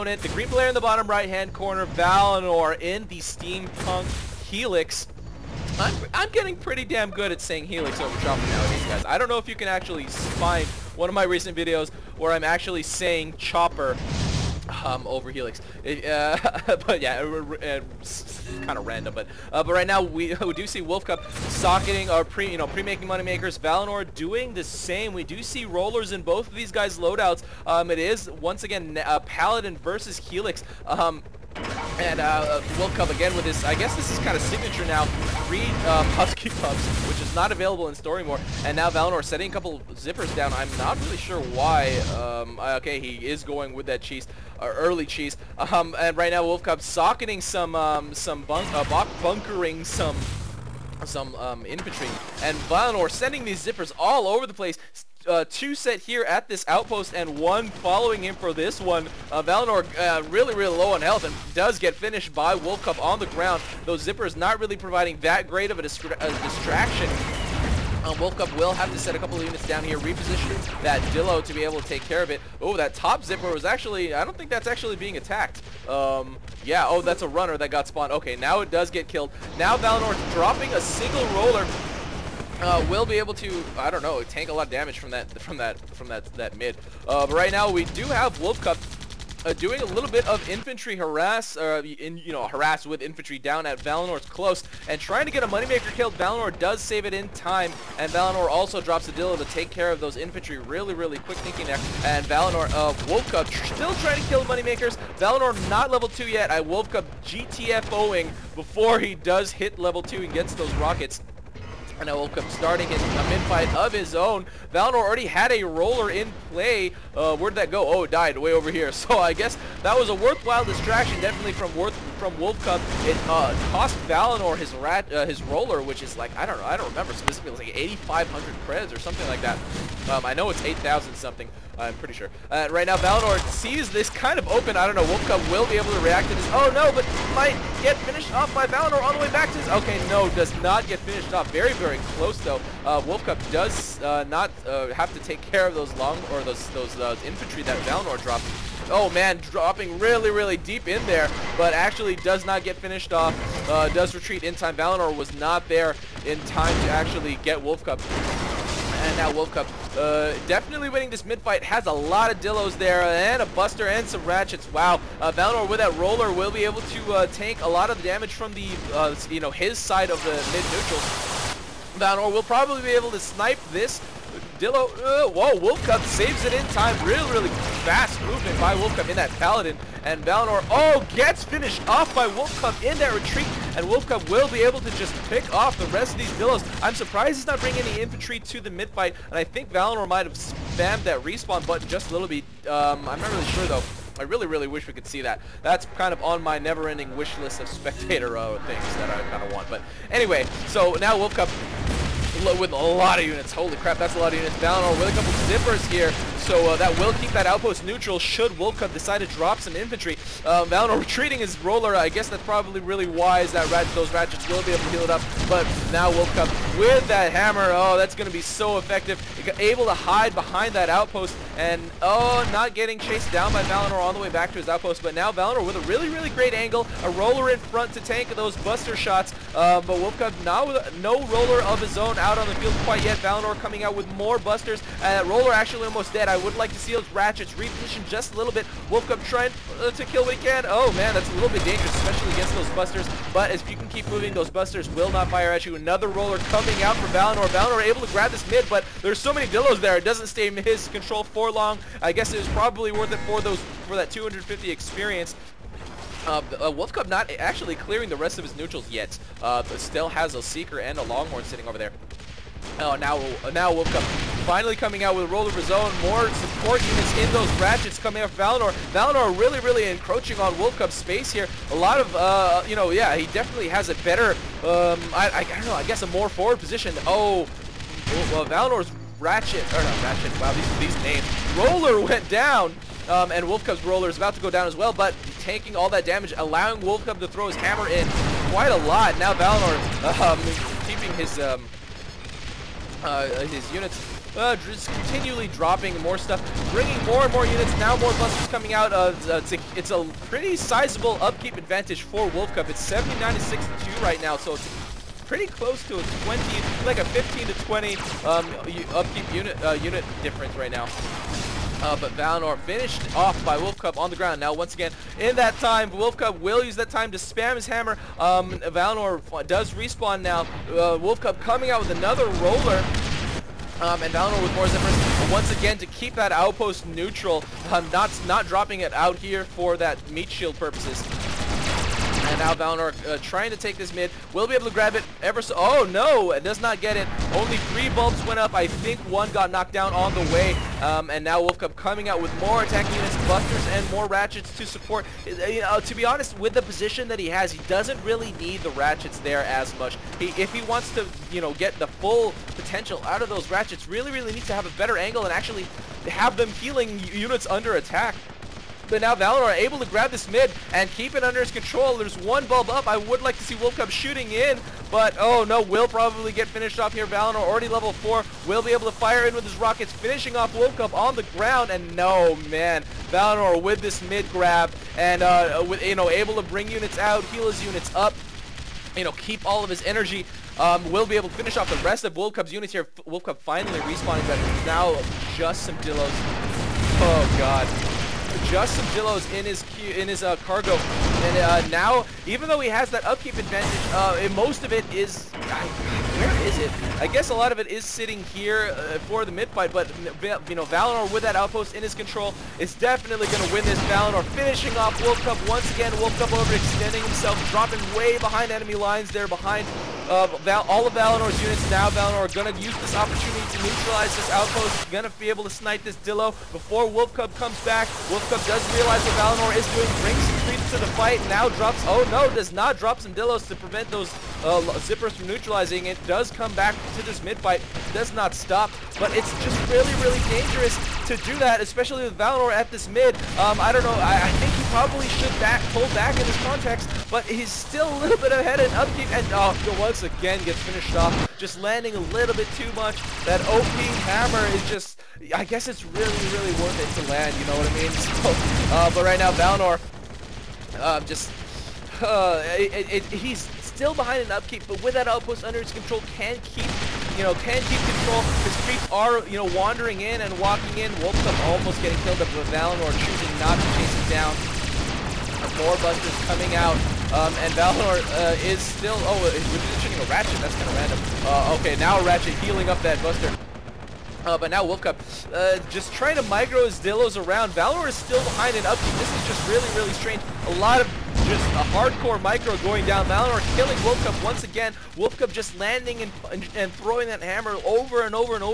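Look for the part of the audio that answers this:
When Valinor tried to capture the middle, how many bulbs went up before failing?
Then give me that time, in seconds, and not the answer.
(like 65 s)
337 s.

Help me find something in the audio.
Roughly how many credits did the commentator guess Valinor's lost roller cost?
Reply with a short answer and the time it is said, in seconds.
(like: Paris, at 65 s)
8,500, at 128 s.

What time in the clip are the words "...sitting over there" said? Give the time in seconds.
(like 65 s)
261 s.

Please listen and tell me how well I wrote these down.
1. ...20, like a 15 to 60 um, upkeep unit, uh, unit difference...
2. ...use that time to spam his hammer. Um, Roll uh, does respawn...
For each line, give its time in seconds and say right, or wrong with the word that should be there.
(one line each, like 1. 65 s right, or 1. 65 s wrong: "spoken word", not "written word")
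1. 306 s wrong: "20", not "60"
2. 316 s wrong: "Valinor", not "Roll".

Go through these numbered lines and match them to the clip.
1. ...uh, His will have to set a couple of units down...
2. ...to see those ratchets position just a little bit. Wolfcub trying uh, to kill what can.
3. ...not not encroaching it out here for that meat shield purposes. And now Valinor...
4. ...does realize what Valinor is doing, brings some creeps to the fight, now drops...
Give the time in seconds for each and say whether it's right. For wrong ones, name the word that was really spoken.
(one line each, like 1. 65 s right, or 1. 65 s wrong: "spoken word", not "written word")
1. 68 s wrong: "Woke", not "His"
2. 236 s wrong: "reposition", not "position"
3. 327 s wrong: "dropping", not "encroaching"
4. 418 s right.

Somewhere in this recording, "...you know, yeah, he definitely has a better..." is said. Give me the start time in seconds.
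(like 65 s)
272 s.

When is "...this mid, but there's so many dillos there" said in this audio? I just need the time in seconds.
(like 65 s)
248 s.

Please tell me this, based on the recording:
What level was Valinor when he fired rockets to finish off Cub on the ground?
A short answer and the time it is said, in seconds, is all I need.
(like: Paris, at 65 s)
4, at 367 s.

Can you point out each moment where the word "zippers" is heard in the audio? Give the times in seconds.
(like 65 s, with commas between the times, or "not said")
39 s, 53 s, 63 s, 73 s, 205 s, 324 s, 424 s.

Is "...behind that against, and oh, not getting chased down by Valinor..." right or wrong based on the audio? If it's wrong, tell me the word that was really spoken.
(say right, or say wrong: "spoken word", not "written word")
wrong: "outpost", not "against".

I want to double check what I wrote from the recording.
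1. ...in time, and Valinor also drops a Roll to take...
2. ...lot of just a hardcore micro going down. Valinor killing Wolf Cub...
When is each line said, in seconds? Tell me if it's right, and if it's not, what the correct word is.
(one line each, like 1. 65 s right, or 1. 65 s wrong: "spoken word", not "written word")
1. 97 s wrong: "Dillo", not "Roll"
2. 480 s right.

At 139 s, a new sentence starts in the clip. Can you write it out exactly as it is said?
Okay, no, does not get finished off.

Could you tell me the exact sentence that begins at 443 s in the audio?
That OP hammer is just, I guess it's really, really worth it to land, you know what I mean?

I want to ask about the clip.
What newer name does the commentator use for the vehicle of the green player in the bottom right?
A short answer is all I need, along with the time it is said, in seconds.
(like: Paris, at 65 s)
Steampunk Helix, at 3 s.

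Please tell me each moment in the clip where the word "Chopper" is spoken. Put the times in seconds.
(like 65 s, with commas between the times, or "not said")
8 s, 13 s.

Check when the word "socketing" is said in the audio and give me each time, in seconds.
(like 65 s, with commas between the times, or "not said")
21 s, 46 s.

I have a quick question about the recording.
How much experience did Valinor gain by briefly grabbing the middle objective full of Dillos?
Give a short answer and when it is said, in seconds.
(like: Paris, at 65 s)
250, at 254 s.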